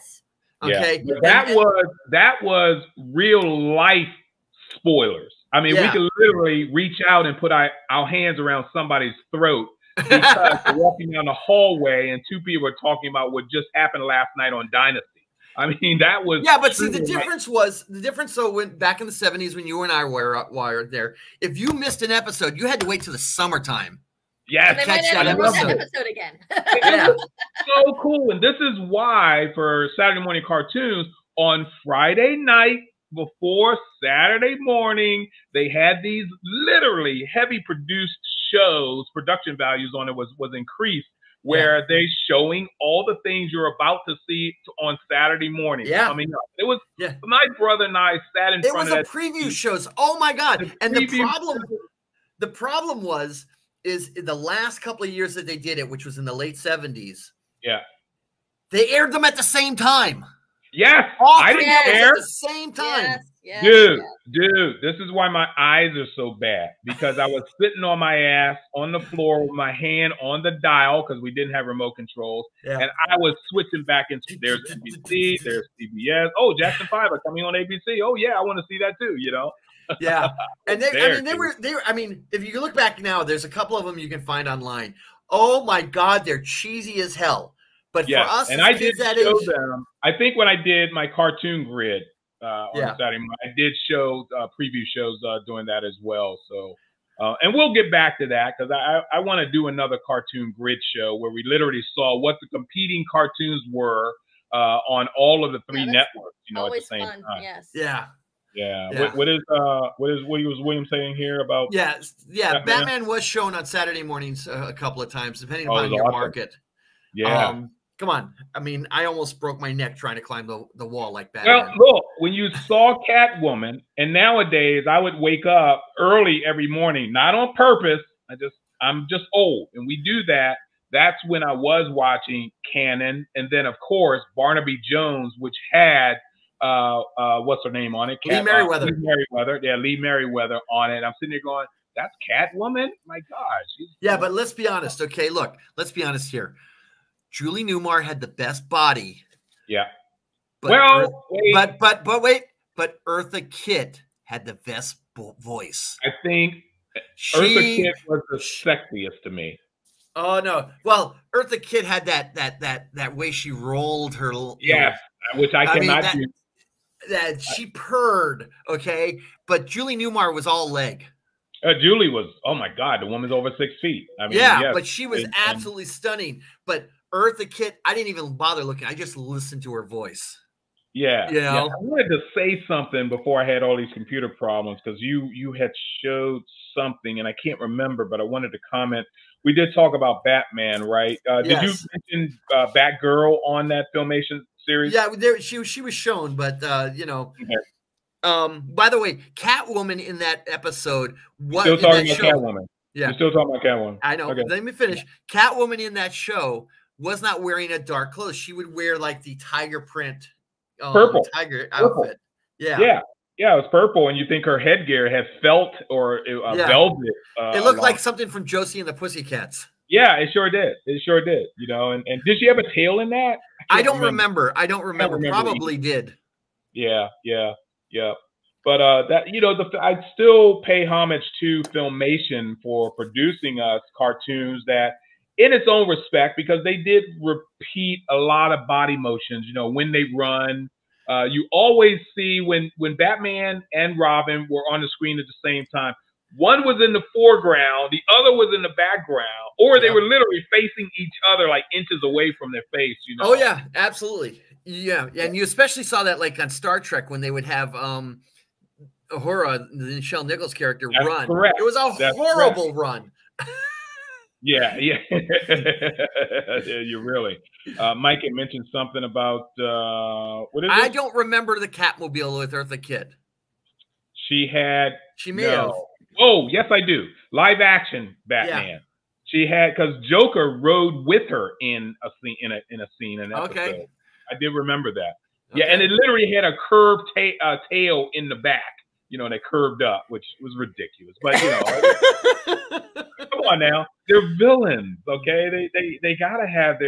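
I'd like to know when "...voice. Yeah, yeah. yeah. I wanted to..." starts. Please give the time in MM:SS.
02:59.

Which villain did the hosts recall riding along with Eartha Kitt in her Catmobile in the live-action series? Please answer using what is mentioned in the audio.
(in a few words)
Joker.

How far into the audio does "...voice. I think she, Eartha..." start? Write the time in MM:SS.
02:35.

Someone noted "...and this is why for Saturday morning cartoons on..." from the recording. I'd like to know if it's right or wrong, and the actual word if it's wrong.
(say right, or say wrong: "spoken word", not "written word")
right.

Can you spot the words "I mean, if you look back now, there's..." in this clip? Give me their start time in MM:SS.
01:21.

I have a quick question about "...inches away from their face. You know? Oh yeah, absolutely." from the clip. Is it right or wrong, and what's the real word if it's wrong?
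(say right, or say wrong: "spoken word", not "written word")
right.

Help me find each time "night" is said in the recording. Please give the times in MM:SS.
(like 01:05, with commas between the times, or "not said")
00:14, 00:32.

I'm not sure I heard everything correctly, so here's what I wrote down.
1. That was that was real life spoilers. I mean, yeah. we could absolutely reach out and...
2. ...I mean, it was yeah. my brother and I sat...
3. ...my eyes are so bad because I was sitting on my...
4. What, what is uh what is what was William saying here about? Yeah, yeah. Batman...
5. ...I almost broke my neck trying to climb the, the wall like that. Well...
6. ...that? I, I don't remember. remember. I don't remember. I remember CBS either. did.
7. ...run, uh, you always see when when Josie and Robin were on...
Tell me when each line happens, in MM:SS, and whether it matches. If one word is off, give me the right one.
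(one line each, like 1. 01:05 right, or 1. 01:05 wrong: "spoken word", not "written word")
1. 00:01 wrong: "literally", not "absolutely"
2. 00:46 right
3. 01:05 right
4. 01:49 right
5. 01:58 right
6. 03:43 wrong: "Probably", not "CBS"
7. 04:00 wrong: "Batman", not "Josie".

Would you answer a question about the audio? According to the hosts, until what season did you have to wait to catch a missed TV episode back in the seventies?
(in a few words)
Summertime.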